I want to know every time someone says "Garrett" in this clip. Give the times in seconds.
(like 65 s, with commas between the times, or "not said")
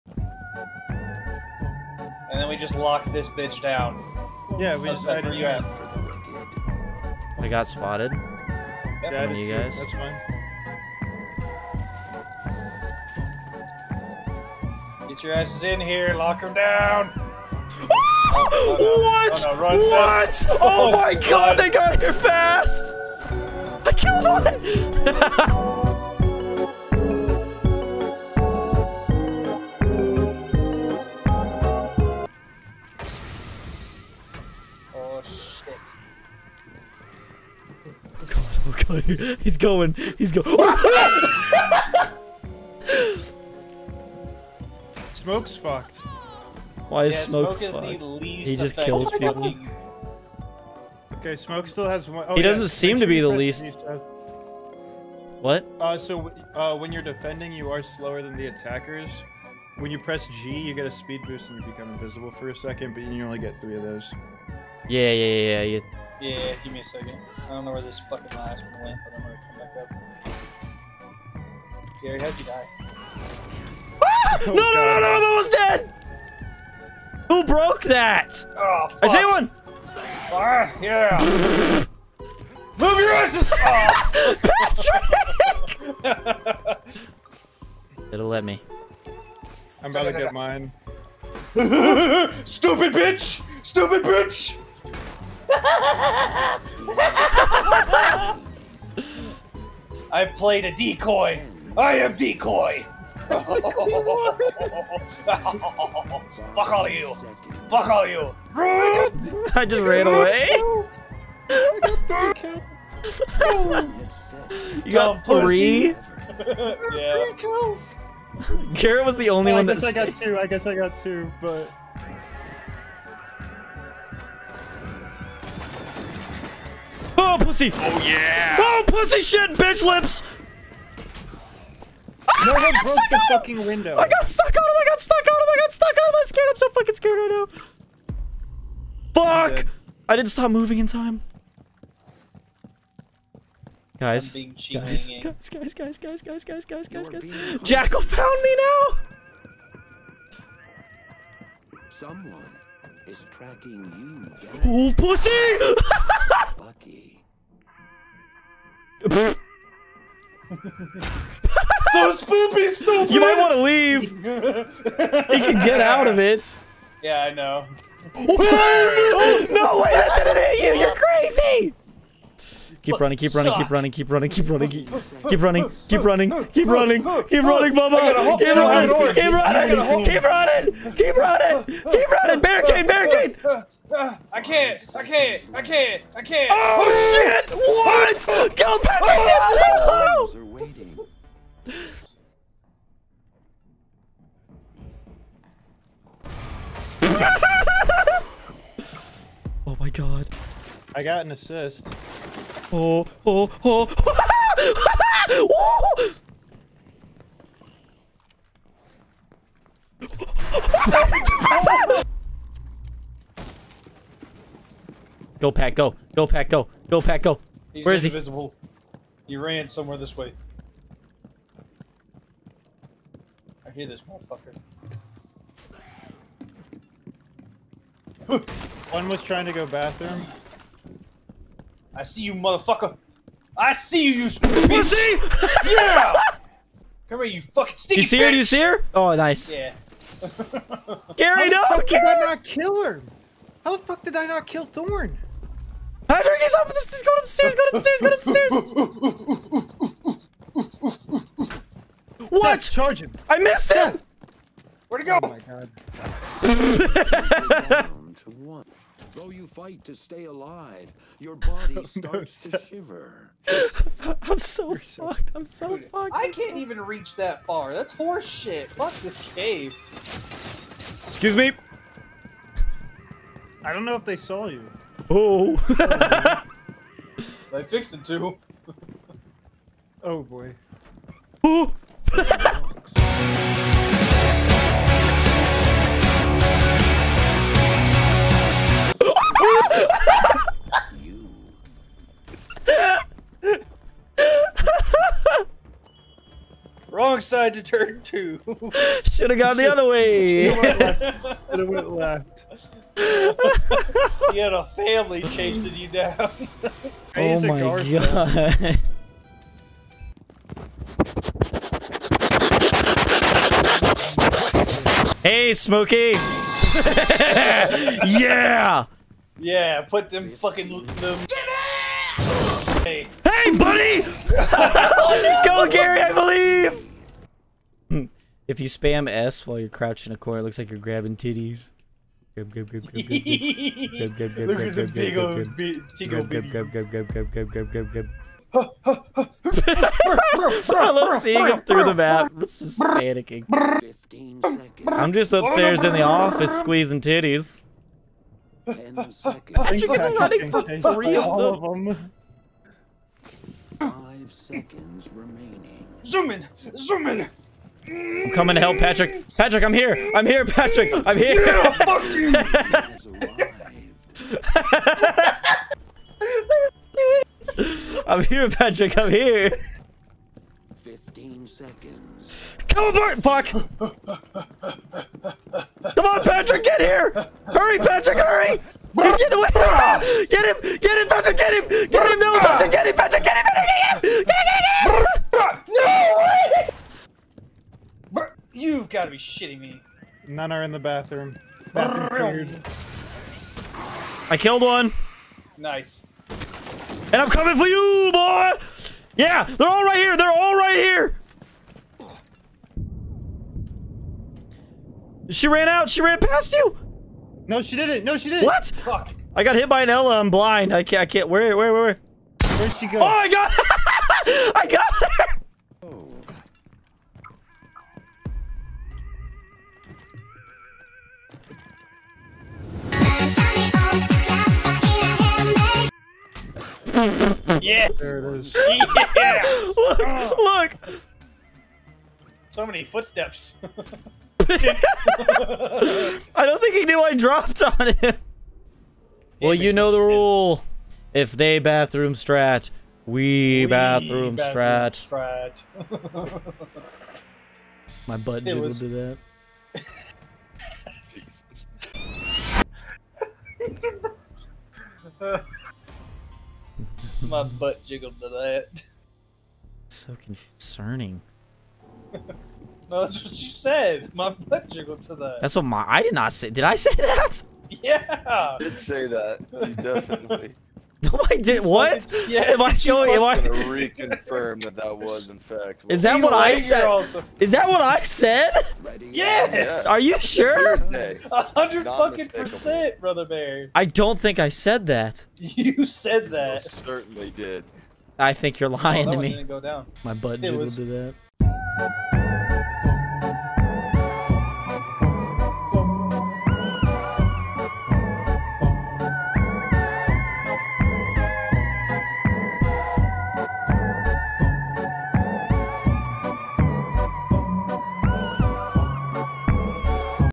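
118 s.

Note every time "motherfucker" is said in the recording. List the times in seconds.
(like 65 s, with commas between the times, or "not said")
224 s, 232 s.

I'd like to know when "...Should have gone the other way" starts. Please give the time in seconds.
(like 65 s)
299 s.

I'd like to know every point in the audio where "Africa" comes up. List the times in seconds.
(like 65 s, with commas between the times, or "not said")
not said.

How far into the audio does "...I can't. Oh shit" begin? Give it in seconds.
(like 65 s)
186 s.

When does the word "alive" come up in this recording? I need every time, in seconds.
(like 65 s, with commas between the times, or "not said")
260 s.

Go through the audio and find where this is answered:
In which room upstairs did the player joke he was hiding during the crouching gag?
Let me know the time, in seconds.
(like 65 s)
345 s.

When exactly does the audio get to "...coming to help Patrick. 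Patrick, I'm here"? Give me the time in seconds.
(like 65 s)
358 s.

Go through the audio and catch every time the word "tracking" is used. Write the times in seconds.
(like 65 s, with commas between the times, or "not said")
153 s.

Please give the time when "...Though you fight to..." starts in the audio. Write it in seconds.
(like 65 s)
259 s.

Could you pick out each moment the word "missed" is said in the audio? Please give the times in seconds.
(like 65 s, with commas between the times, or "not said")
253 s.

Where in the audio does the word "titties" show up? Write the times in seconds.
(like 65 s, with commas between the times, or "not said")
331 s, 347 s.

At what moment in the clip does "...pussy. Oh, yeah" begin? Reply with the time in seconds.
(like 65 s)
127 s.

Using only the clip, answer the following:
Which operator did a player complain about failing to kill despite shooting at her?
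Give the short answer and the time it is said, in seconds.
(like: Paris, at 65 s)
Thorn, at 243 s.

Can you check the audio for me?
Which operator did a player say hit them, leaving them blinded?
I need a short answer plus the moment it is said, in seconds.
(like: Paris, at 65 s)
Ela, at 409 s.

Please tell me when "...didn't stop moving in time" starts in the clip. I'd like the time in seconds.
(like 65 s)
140 s.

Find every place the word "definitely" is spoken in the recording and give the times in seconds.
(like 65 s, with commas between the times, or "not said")
469 s.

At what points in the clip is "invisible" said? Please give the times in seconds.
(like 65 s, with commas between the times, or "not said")
61 s, 218 s.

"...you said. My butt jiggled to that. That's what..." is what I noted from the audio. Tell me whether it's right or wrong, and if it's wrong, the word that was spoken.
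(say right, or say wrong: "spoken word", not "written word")
right.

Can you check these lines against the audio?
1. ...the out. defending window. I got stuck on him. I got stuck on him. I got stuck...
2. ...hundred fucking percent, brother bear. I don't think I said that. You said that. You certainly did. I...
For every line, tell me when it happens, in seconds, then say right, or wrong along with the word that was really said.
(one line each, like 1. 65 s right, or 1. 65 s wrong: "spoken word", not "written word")
1. 133 s wrong: "fucking", not "defending"
2. 481 s right.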